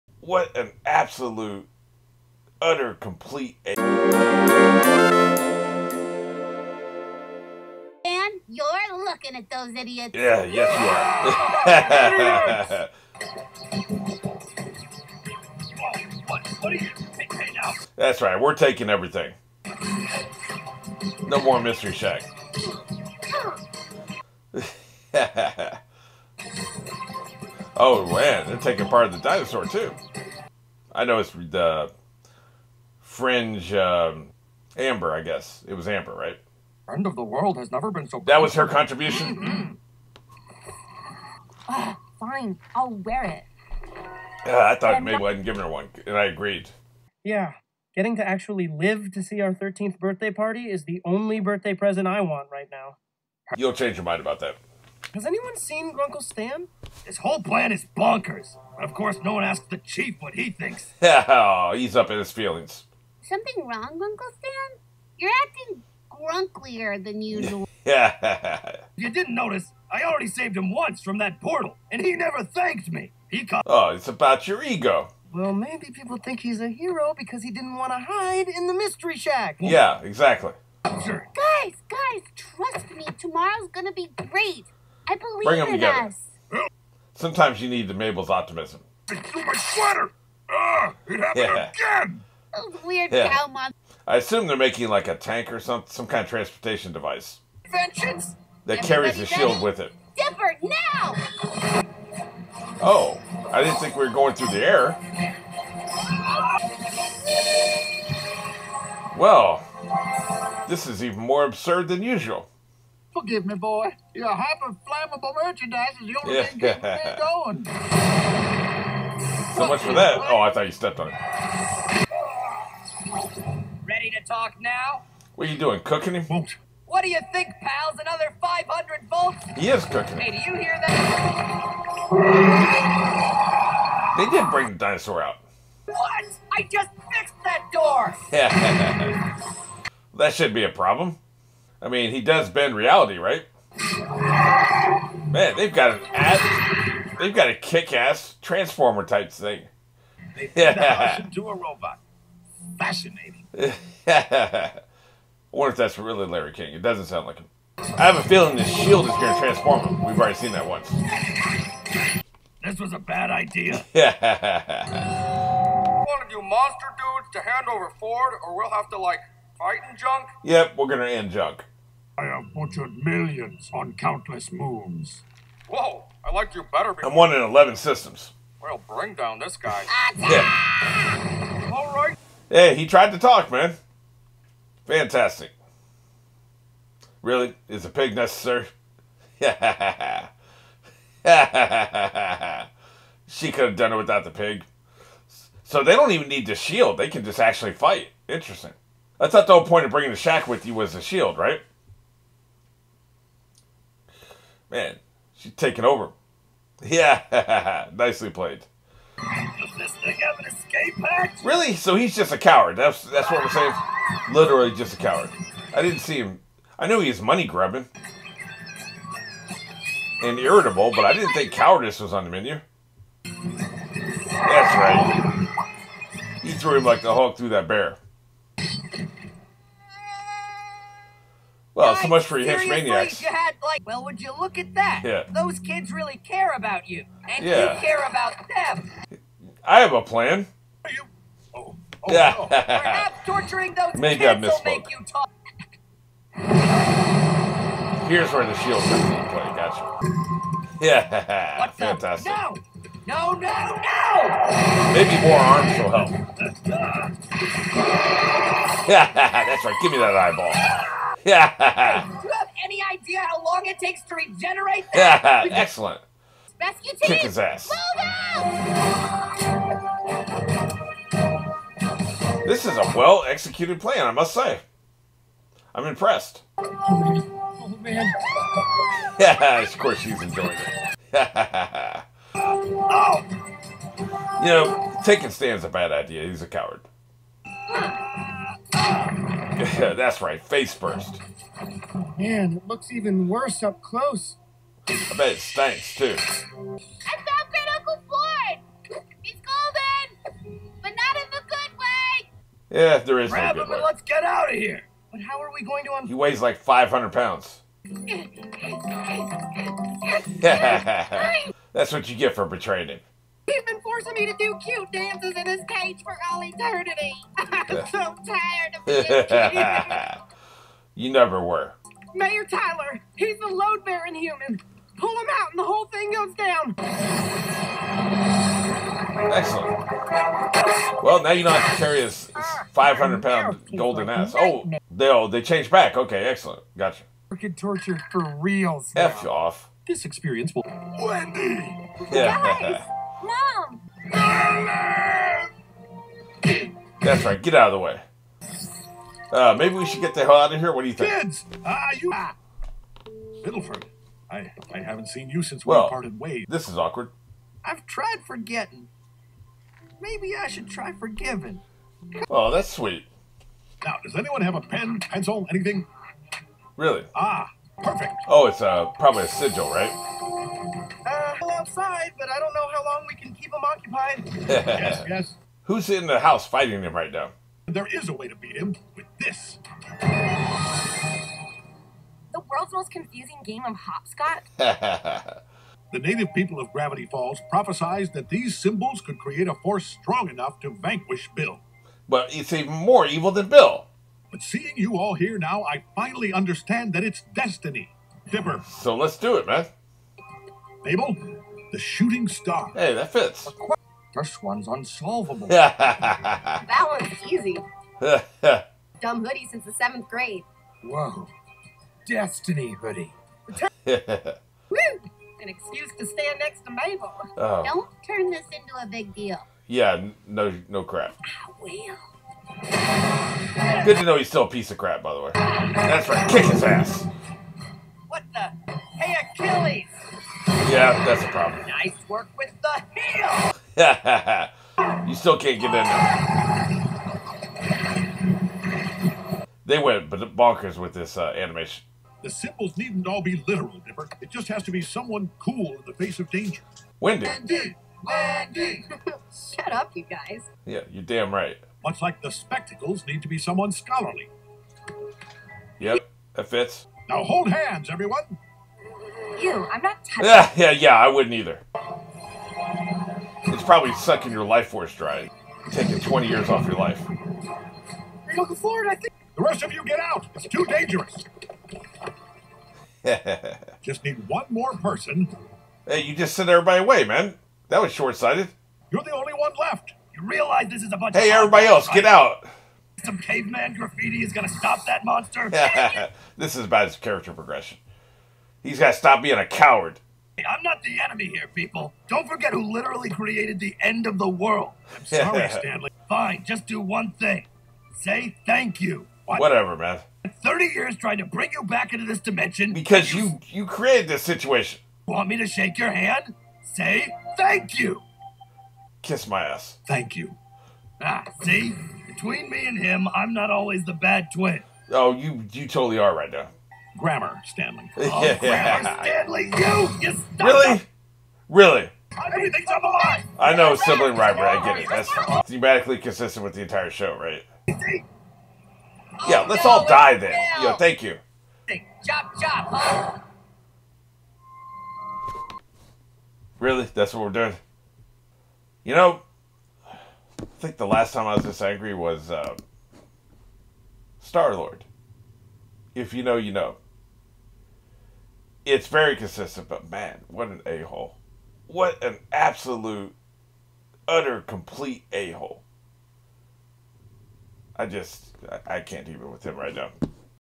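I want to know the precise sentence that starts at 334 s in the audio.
Oh, they, oh, they changed back.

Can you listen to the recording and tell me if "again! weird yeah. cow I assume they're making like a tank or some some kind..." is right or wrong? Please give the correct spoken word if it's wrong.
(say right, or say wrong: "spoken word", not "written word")
right.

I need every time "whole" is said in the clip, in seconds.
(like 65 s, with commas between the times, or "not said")
57 s, 199 s, 325 s.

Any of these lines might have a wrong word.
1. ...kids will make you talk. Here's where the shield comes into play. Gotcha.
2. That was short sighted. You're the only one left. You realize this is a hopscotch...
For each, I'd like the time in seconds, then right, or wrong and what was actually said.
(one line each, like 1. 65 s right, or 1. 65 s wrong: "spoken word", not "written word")
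1. 244 s right
2. 477 s wrong: "bunch", not "hopscotch".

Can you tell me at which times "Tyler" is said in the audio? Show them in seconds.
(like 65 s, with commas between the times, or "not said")
322 s.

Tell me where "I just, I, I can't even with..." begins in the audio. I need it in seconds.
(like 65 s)
557 s.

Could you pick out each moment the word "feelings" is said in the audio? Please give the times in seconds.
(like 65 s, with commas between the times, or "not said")
62 s, 158 s.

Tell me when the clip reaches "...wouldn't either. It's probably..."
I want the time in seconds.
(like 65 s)
461 s.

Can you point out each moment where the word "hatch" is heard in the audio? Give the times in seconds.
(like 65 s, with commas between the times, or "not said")
211 s.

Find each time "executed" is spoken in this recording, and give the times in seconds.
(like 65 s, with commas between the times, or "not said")
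273 s.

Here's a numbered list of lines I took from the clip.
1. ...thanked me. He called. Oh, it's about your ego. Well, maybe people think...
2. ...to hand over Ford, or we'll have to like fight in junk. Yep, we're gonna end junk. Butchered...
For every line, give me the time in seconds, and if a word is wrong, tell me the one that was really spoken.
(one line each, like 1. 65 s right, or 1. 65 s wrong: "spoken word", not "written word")
1. 72 s right
2. 167 s right.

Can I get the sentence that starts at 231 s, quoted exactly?
Well, so much for you Henchmaniacs.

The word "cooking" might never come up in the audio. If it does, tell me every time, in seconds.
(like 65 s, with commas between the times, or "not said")
125 s, 129 s.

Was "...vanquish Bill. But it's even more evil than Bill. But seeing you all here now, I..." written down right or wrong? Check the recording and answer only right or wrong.
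right.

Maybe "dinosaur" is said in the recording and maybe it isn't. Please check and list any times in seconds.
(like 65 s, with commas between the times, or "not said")
29 s, 134 s.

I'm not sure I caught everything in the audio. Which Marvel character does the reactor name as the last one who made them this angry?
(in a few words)
Star Lord.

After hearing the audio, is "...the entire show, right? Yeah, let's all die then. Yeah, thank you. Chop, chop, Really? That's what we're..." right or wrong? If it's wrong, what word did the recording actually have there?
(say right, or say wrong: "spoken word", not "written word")
right.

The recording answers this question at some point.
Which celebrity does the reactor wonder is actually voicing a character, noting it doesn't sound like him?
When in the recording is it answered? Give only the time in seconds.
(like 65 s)
156 s.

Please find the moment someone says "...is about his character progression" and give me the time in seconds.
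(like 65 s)
486 s.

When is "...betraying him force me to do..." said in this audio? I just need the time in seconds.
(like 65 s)
312 s.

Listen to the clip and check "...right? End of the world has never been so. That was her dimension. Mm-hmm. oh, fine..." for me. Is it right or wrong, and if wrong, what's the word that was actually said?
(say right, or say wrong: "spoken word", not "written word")
wrong: "contribution", not "dimension".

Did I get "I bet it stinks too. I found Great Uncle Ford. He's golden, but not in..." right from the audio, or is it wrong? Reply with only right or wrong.
right.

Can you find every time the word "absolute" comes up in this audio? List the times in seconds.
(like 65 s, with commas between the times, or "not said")
0 s, 552 s.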